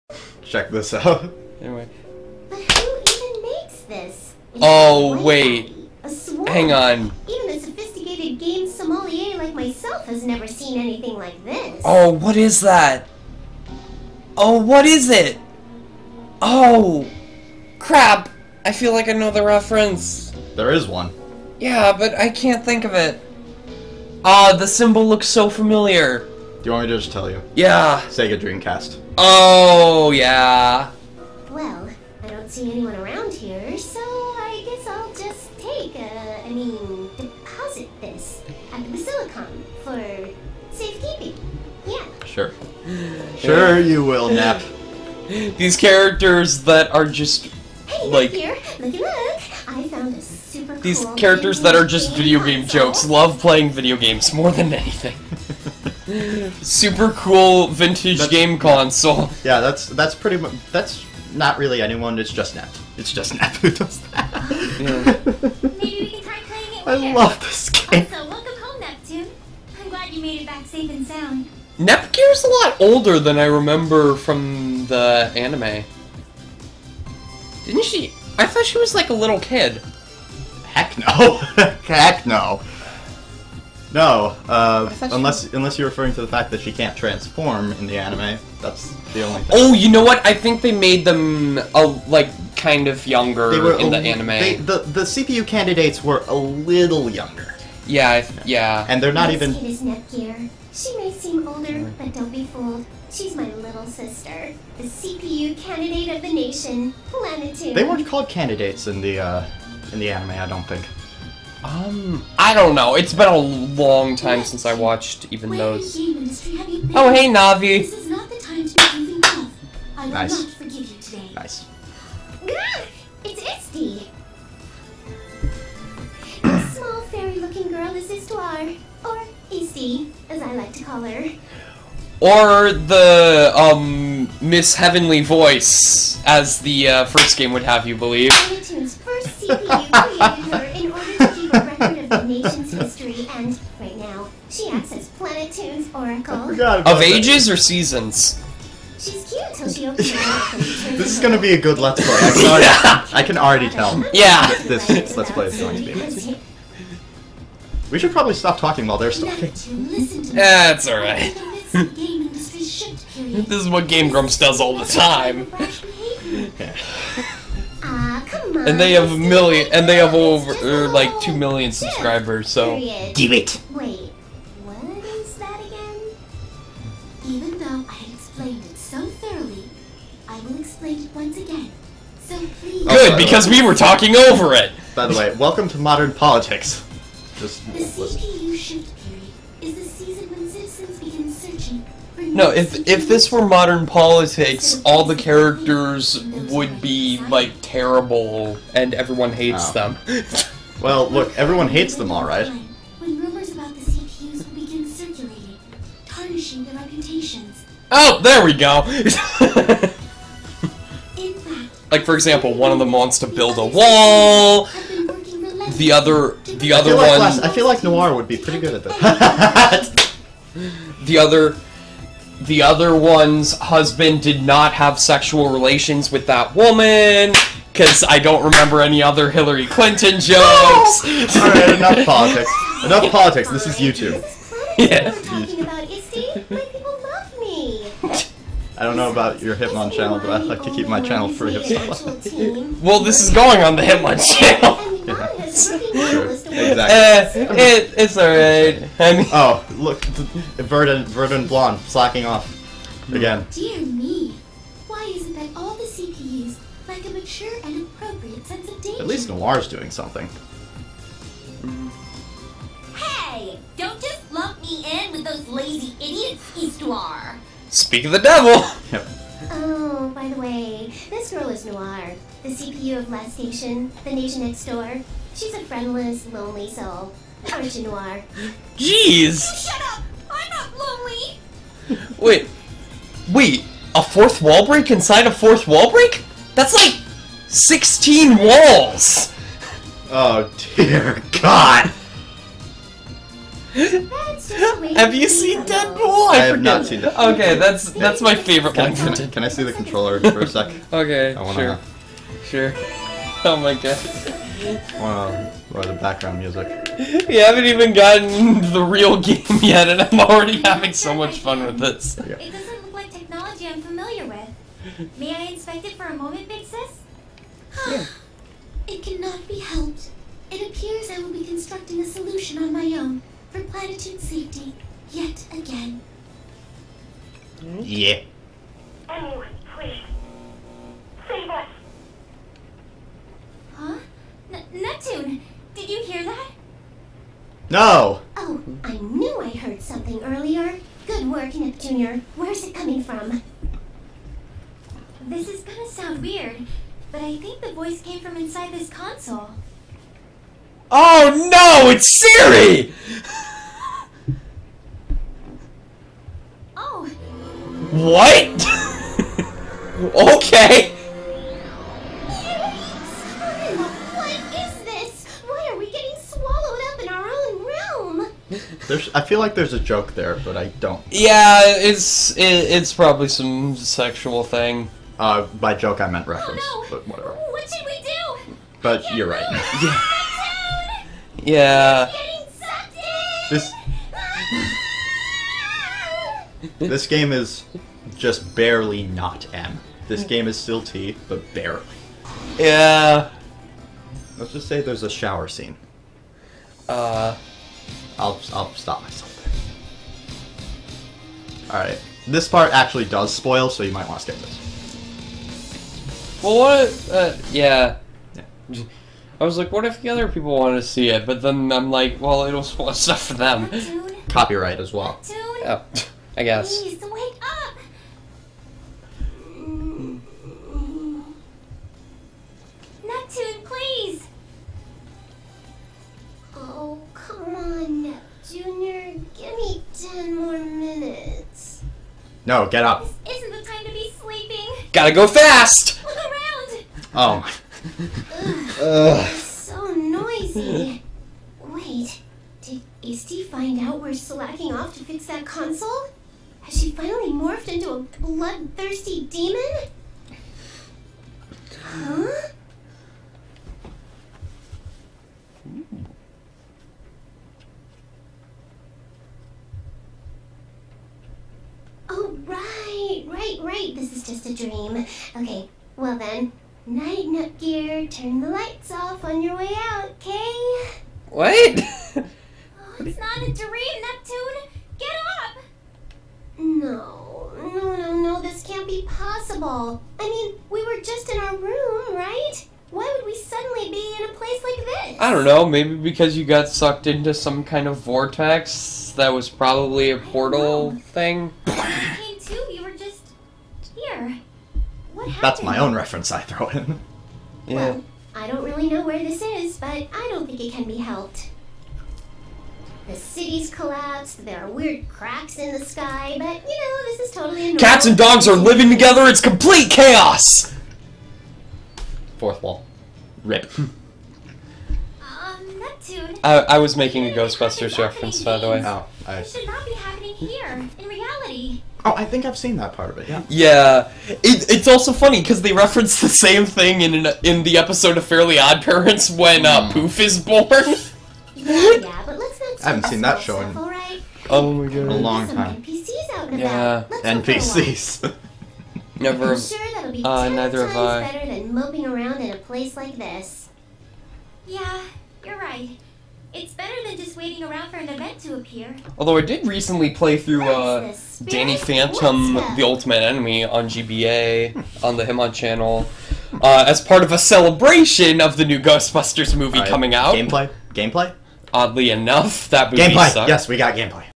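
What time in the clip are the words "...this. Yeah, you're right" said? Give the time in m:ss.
9:03.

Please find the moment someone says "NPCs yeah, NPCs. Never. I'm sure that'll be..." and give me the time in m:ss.
8:55.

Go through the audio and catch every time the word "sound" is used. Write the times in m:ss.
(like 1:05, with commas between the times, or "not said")
1:11, 5:45.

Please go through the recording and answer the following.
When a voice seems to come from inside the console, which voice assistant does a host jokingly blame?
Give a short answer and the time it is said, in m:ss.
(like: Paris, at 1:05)
Siri, at 5:52.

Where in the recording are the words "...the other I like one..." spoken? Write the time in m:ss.
3:36.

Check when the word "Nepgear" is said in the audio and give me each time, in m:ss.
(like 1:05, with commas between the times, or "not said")
1:11, 7:47.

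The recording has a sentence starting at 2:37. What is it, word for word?
We should probably stop talking while they're talking.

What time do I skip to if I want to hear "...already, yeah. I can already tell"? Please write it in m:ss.
2:33.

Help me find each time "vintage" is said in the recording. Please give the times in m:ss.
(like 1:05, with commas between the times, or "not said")
0:57.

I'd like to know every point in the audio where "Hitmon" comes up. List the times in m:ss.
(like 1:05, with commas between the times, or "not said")
3:59, 4:03, 9:15.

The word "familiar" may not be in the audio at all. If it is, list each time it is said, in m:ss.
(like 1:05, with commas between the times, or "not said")
0:25, 5:13.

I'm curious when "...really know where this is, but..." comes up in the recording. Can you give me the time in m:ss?
8:18.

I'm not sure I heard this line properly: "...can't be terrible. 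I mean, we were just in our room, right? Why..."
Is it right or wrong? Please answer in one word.
wrong.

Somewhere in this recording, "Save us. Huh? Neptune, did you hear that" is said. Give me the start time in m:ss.
5:31.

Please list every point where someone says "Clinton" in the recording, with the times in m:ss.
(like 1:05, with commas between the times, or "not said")
3:49.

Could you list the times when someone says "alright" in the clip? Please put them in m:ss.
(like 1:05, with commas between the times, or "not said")
2:40, 3:51, 4:08.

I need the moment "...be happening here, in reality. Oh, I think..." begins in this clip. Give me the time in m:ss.
8:39.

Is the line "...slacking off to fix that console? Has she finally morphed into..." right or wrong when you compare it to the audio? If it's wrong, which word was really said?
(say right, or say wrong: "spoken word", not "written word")
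right.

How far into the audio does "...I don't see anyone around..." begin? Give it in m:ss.
0:32.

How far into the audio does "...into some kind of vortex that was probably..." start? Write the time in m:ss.
8:07.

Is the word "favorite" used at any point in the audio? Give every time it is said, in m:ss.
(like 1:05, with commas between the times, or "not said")
4:58.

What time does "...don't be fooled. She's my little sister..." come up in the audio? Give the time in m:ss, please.
1:42.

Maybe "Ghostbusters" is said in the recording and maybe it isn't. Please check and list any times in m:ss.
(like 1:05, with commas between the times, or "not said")
8:37, 9:18.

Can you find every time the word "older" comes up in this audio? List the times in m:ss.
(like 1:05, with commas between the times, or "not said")
1:12, 1:41.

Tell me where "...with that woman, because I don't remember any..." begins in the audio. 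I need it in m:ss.
3:46.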